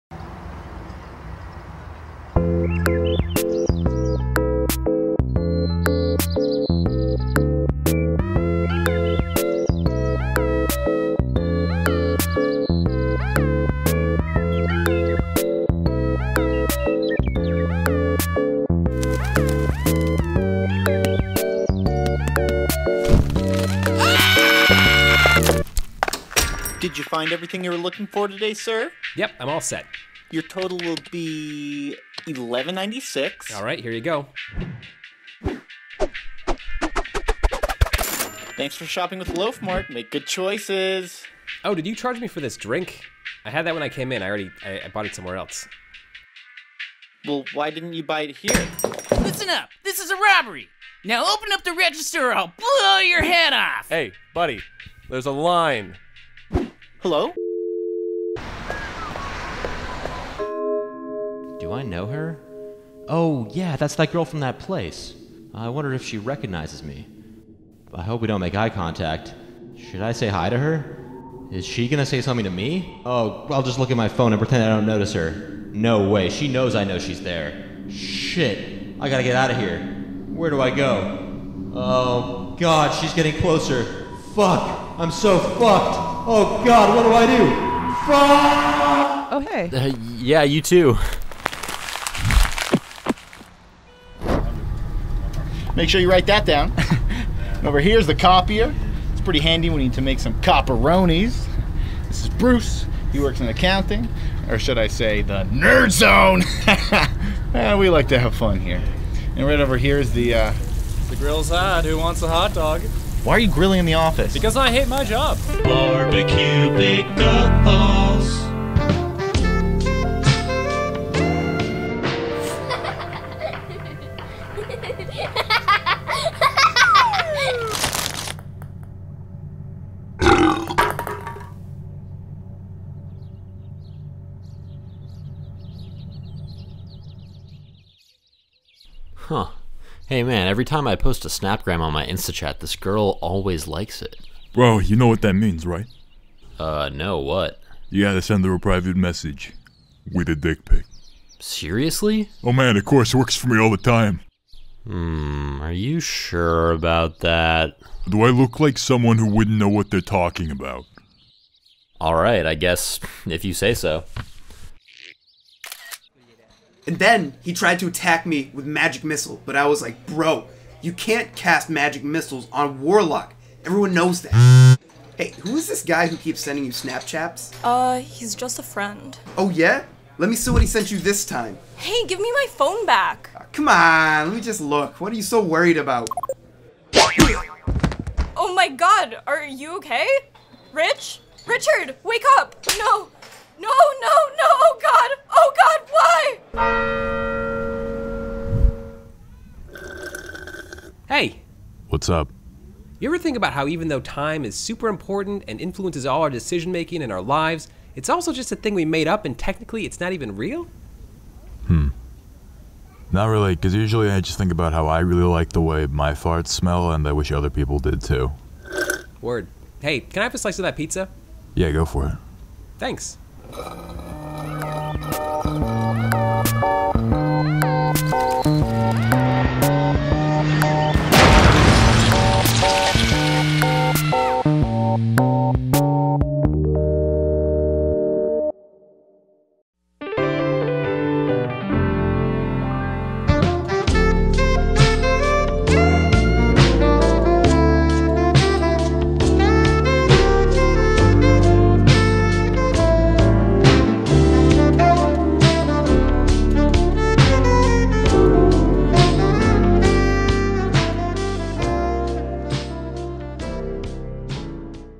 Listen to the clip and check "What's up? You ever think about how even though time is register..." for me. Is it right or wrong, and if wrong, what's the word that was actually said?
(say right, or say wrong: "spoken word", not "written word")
wrong: "super", not "register".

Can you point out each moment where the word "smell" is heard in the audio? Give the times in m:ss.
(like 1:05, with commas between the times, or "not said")
3:36.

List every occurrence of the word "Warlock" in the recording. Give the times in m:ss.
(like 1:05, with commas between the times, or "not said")
2:52.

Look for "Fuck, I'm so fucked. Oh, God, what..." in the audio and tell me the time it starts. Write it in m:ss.
1:24.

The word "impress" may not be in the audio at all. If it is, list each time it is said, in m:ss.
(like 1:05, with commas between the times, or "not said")
not said.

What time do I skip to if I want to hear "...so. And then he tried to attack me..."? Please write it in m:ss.
2:43.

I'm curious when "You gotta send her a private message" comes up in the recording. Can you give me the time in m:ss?
2:27.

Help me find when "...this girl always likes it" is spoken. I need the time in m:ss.
2:22.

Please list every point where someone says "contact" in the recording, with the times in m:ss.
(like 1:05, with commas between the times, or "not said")
1:08.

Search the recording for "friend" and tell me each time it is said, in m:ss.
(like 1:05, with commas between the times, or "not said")
2:58.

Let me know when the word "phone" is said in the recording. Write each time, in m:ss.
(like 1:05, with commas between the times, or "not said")
1:14, 3:02.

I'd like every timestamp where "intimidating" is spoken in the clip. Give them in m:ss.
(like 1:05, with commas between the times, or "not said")
not said.